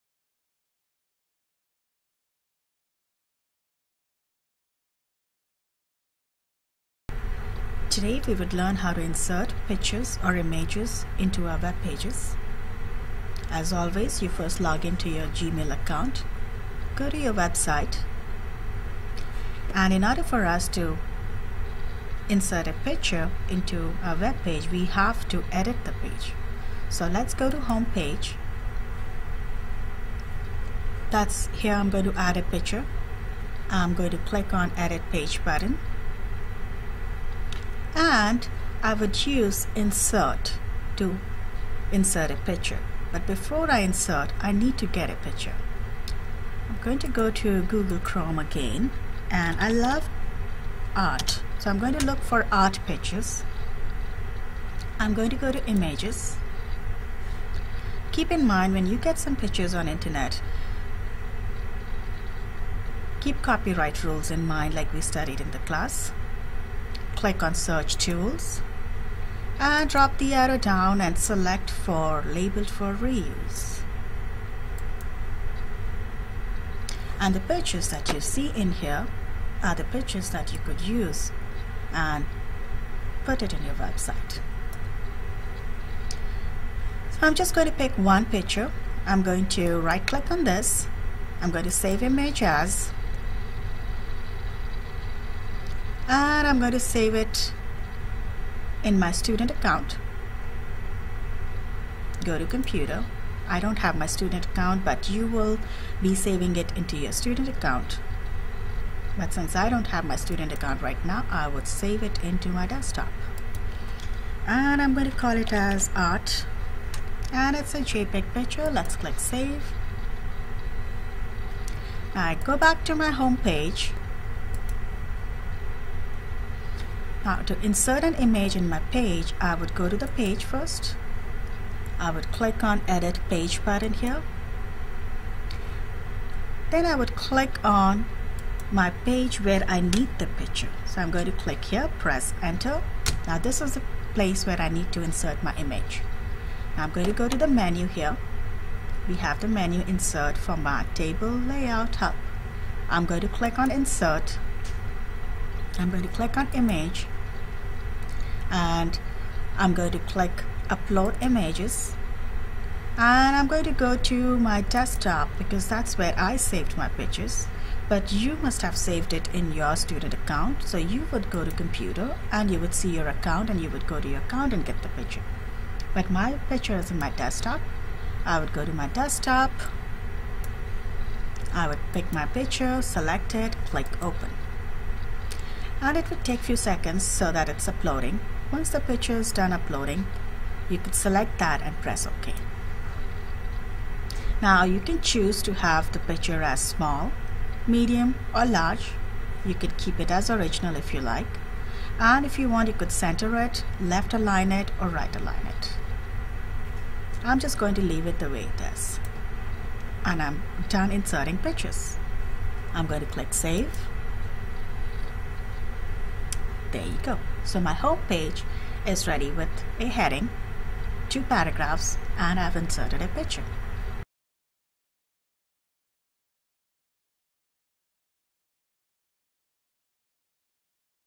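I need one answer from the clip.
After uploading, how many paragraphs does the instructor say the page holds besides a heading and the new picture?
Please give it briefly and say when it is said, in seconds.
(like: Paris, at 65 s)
2, at 221 s.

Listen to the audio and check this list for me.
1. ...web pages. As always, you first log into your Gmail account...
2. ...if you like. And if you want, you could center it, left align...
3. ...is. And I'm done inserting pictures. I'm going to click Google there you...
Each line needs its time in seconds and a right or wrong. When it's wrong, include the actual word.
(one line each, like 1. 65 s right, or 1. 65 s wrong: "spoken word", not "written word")
1. 11 s right
2. 200 s right
3. 208 s wrong: "Save", not "Google".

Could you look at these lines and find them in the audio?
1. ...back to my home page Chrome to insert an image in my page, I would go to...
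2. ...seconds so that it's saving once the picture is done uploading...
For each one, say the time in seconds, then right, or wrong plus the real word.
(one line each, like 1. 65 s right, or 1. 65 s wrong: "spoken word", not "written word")
1. 122 s wrong: "Now", not "Chrome"
2. 186 s wrong: "uploading", not "saving".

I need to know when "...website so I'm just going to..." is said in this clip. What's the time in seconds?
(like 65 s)
83 s.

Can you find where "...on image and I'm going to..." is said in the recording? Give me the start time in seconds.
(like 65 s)
156 s.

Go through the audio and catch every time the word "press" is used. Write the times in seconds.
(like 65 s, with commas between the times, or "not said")
141 s, 191 s.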